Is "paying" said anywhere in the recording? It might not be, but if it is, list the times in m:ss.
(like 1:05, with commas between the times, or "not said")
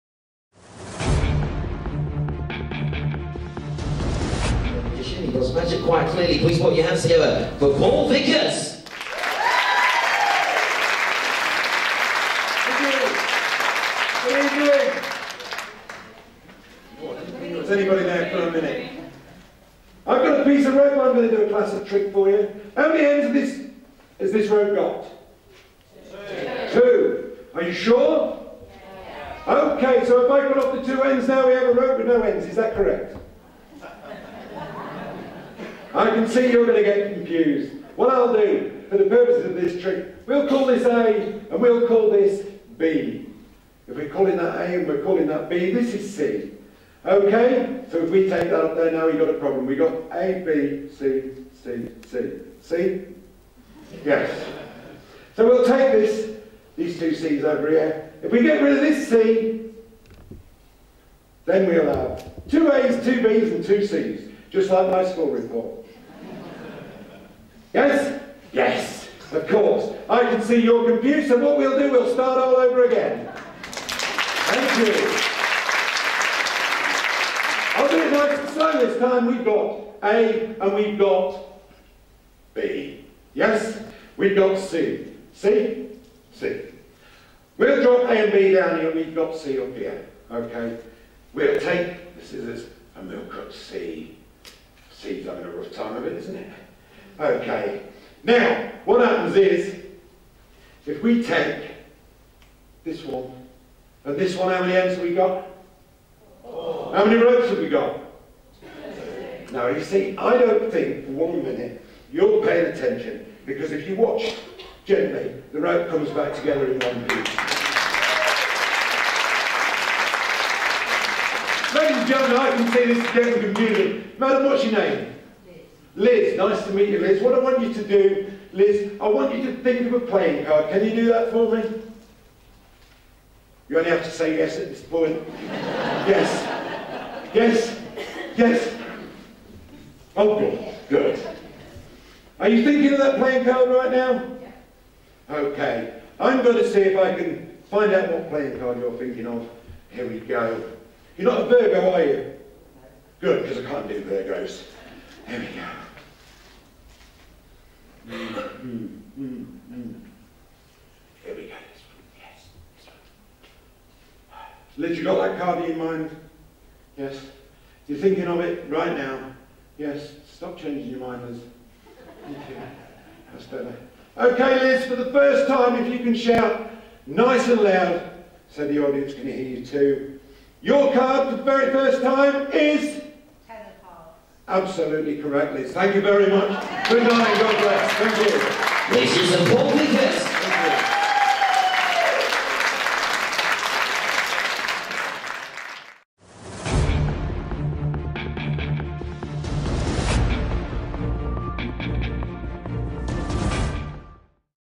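1:52.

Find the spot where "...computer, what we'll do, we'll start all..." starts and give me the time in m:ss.
1:10.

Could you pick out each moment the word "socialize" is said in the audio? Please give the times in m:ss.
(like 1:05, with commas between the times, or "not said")
not said.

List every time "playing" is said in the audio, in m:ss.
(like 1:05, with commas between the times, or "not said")
2:10, 2:23, 2:28.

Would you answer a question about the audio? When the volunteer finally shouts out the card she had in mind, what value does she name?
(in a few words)
10.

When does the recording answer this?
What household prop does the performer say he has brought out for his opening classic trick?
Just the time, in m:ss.
0:20.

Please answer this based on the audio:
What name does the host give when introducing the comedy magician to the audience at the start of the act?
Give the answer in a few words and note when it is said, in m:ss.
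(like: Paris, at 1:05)
Paul Vickers, at 0:07.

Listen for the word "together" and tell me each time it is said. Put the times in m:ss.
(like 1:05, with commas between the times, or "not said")
0:07, 1:56.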